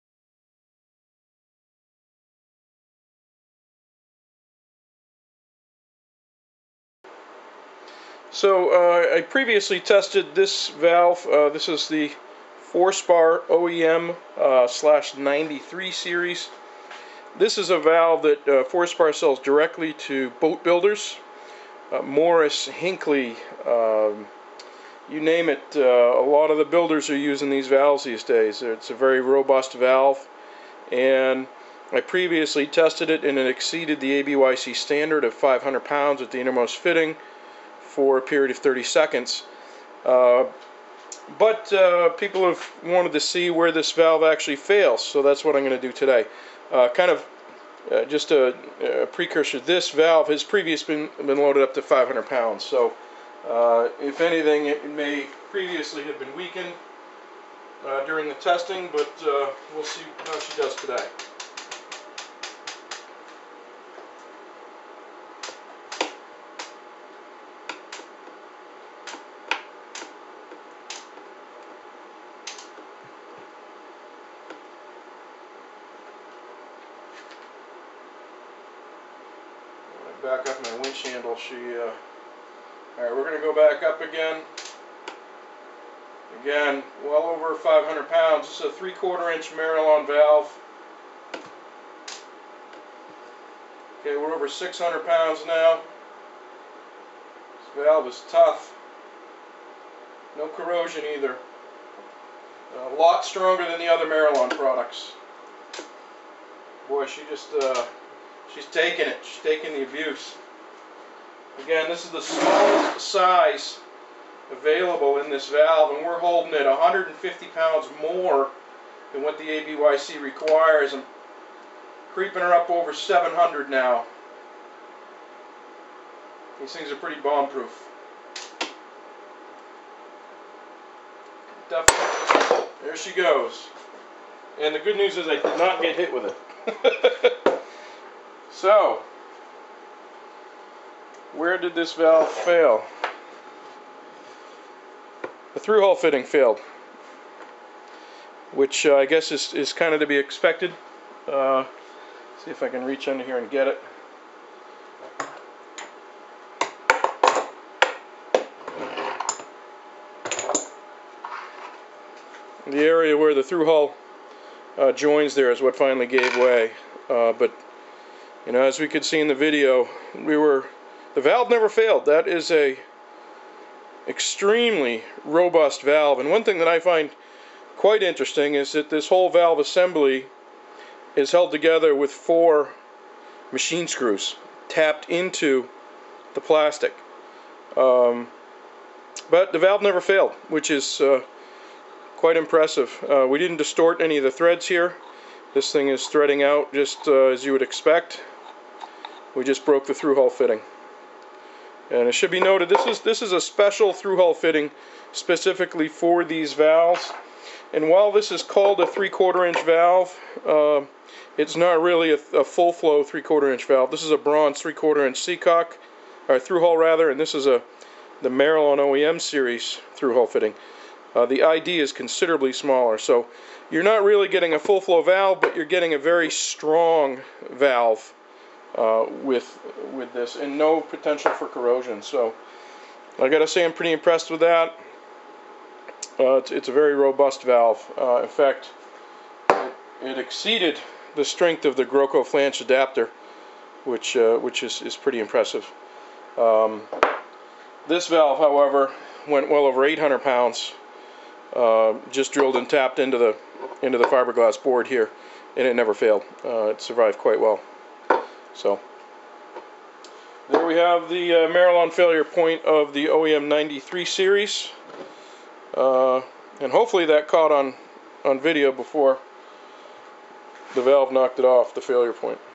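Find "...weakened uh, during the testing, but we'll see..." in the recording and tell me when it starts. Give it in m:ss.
0:56.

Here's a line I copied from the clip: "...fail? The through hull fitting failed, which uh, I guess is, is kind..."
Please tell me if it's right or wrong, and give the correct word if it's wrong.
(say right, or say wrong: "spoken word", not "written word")
right.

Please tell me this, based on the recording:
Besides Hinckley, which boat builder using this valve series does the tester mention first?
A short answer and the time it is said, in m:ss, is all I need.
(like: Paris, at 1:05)
Morris, at 0:22.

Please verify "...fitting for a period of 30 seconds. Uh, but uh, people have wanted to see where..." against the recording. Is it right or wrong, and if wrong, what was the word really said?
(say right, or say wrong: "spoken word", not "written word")
right.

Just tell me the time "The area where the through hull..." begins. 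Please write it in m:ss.
2:42.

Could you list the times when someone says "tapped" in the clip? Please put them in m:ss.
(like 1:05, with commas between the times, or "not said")
3:04, 4:12.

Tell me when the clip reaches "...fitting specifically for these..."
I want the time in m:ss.
3:24.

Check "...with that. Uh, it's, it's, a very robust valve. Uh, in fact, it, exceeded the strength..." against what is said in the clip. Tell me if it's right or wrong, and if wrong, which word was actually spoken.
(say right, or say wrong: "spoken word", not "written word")
right.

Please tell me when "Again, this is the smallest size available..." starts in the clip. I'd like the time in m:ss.
1:51.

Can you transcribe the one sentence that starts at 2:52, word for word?
That is a extremely robust valve.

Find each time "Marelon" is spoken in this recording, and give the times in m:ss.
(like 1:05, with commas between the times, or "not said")
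1:29, 1:44, 3:38, 4:21.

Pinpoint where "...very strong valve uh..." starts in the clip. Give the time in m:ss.
3:45.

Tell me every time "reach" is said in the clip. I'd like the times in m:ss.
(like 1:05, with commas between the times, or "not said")
2:32.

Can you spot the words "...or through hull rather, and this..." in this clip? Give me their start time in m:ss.
3:36.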